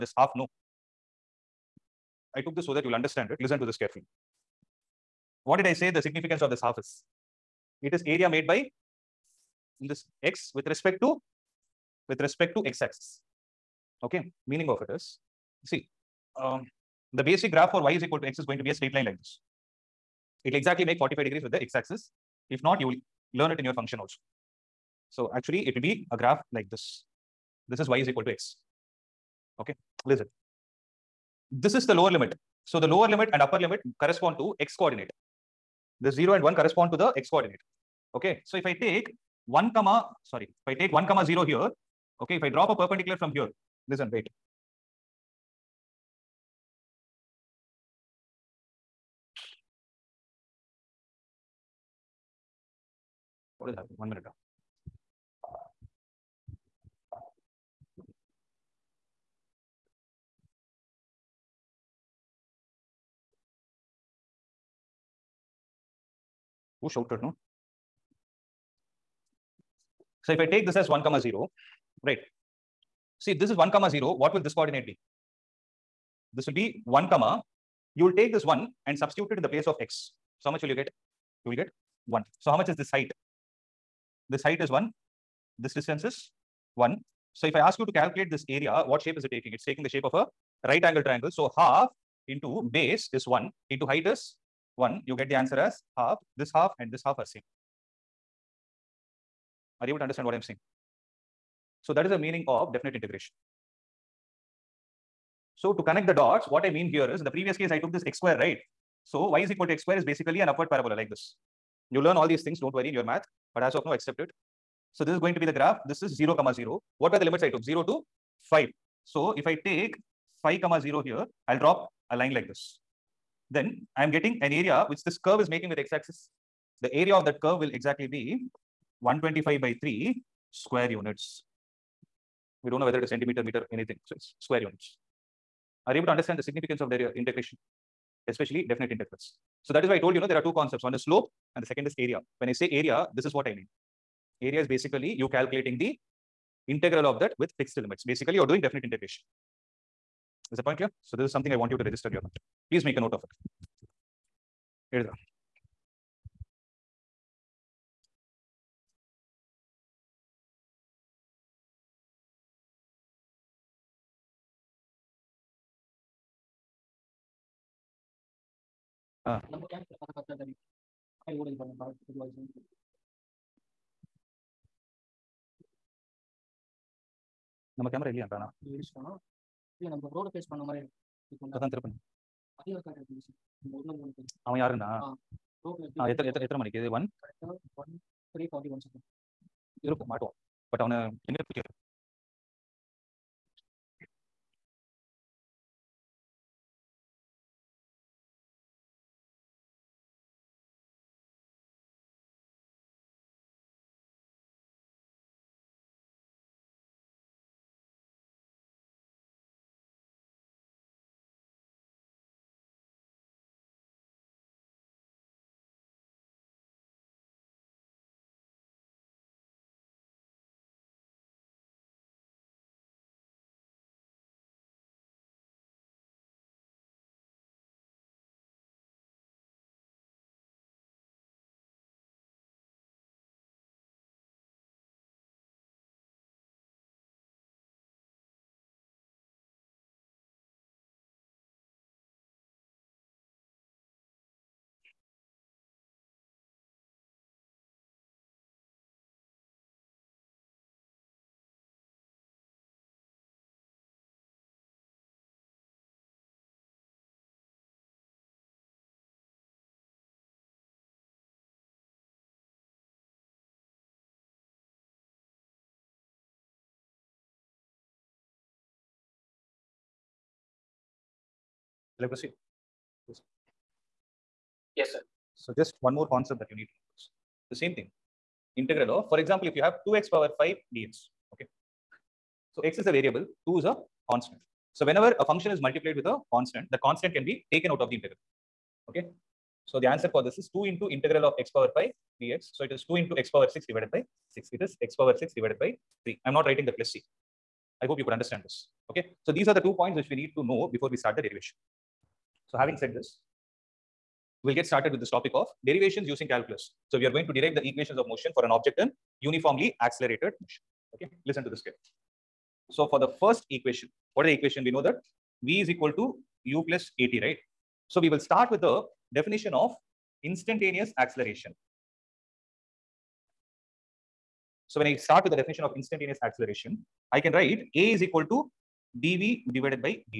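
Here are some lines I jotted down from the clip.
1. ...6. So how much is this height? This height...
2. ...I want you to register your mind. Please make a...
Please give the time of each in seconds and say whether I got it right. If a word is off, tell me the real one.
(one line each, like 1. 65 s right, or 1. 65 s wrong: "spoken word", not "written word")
1. 82 s wrong: "1", not "6"
2. 151 s right.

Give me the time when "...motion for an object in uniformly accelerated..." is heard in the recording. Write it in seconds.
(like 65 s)
308 s.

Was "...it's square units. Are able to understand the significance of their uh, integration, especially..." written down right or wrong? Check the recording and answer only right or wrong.
right.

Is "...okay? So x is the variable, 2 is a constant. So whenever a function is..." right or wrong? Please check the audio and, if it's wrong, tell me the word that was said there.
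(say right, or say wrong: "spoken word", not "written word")
right.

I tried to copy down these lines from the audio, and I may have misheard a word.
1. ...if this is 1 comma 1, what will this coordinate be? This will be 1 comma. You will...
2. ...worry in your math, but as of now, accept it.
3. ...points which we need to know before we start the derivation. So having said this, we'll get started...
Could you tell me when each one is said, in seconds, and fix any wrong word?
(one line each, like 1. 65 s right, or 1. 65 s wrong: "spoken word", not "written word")
1. 73 s wrong: "0", not "1"
2. 112 s right
3. 299 s right.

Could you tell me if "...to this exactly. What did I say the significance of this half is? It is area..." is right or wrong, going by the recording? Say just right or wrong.
wrong.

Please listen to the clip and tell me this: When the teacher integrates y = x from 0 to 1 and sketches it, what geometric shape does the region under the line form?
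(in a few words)
right angle triangle.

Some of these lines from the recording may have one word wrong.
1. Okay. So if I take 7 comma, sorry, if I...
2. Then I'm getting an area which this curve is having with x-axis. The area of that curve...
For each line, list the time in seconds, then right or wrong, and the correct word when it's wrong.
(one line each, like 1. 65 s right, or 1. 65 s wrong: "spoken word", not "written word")
1. 38 s wrong: "1", not "7"
2. 123 s wrong: "making", not "having".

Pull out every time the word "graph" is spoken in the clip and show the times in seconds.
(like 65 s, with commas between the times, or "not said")
17 s, 26 s, 115 s.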